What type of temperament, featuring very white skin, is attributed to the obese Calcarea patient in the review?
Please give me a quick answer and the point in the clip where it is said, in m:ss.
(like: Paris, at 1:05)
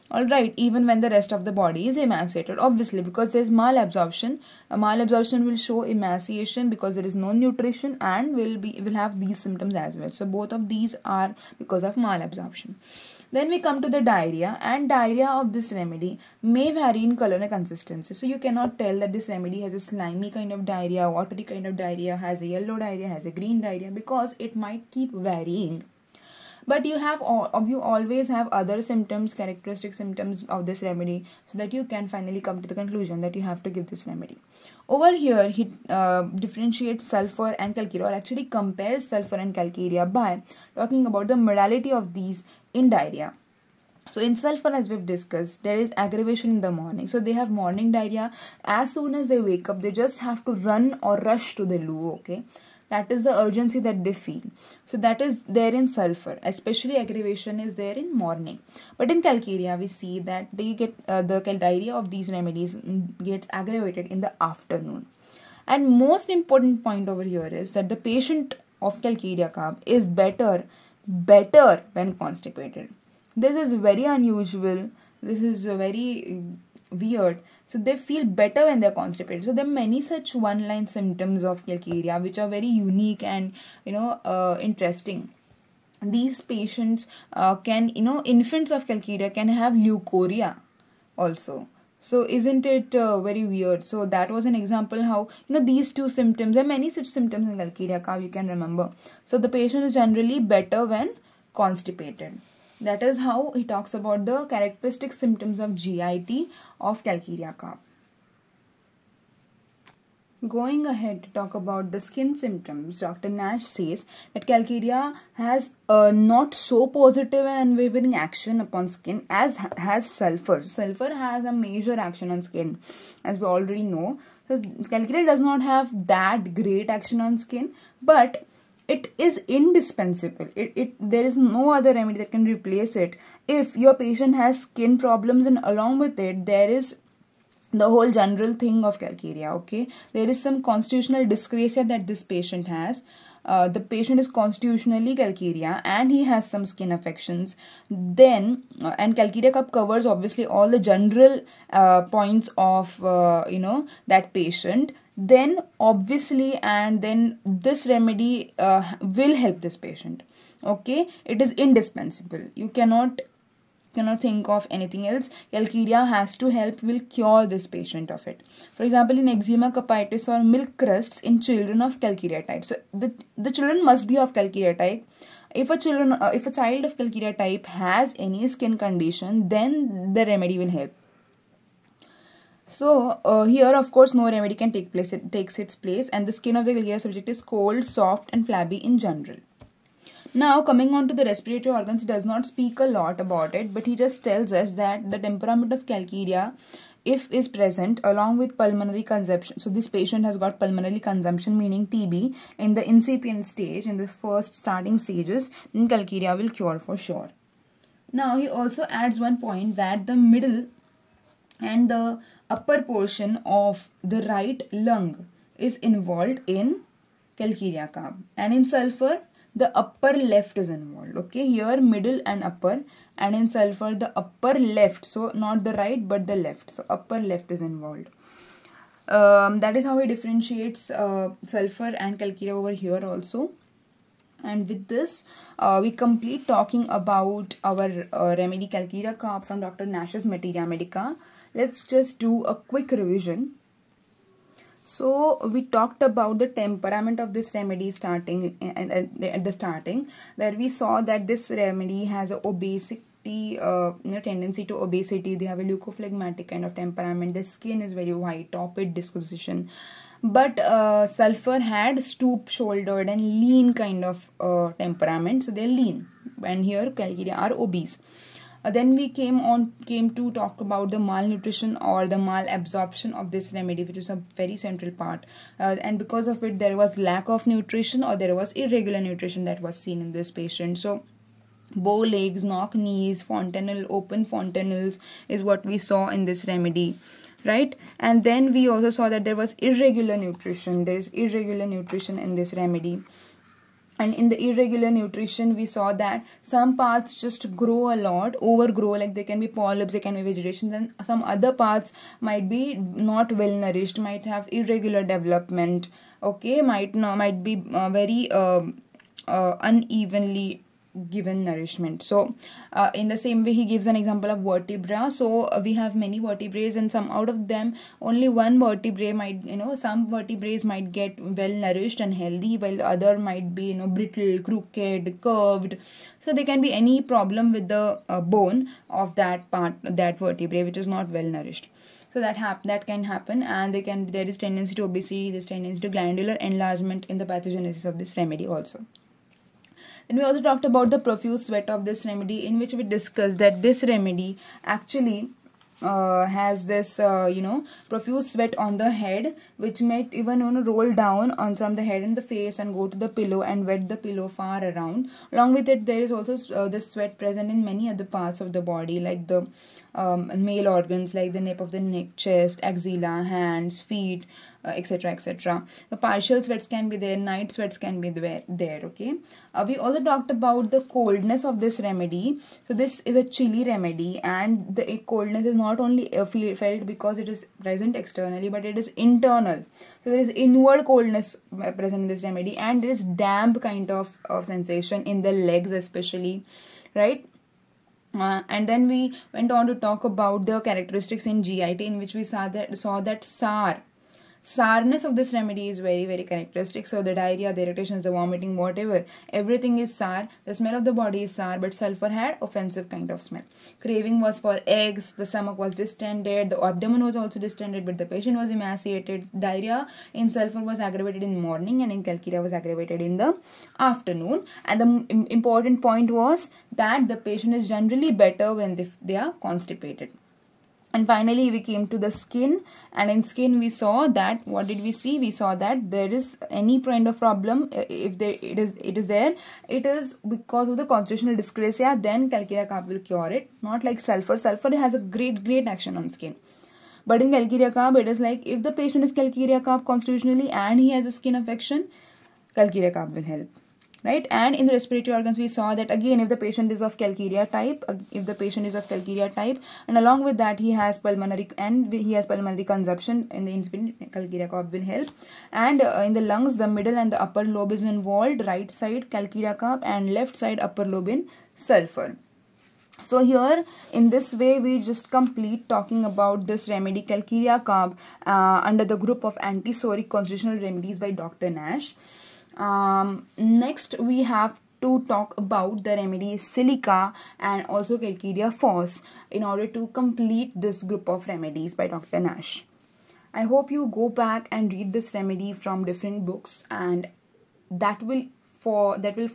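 Leukophlegmatic, at 4:15.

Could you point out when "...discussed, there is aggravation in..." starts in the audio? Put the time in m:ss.
0:45.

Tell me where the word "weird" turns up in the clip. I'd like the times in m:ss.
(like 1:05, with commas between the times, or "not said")
1:17, 1:33.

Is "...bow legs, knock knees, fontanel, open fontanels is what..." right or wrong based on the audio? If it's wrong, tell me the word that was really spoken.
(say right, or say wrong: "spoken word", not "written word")
right.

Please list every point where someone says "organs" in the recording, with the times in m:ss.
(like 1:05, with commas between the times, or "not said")
3:11, 6:00, 7:25.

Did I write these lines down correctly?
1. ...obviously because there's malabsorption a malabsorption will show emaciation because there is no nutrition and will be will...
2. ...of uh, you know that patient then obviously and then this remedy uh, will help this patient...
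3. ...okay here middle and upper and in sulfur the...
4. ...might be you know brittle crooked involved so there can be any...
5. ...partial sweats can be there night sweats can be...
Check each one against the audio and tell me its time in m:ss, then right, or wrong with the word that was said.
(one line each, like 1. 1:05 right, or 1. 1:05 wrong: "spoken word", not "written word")
1. 0:02 right
2. 2:32 right
3. 3:41 right
4. 5:23 wrong: "curved", not "involved"
5. 6:06 right.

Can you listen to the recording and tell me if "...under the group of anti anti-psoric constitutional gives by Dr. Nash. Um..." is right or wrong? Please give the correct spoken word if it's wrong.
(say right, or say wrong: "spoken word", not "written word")
wrong: "remedies", not "gives".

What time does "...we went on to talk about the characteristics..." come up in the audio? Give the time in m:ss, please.
6:28.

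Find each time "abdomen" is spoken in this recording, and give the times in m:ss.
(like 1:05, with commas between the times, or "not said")
6:46.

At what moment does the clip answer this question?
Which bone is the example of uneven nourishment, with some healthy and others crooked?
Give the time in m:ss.
5:14.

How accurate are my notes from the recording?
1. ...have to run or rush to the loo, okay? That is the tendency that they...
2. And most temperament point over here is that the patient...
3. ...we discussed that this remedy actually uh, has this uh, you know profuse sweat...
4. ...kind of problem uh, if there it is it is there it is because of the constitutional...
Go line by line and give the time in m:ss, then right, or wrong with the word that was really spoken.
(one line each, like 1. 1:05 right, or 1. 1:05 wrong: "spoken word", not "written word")
1. 0:50 wrong: "urgency", not "tendency"
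2. 1:05 wrong: "important", not "temperament"
3. 5:42 right
4. 7:06 right.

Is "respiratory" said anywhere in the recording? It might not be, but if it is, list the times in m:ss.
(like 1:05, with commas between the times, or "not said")
3:11, 7:24.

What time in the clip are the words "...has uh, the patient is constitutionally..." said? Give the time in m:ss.
2:22.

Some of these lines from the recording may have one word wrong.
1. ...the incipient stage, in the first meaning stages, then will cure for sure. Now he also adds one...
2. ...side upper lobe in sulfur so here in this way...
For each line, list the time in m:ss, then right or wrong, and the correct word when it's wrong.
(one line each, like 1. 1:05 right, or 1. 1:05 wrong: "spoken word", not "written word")
1. 3:22 wrong: "starting", not "meaning"
2. 7:40 right.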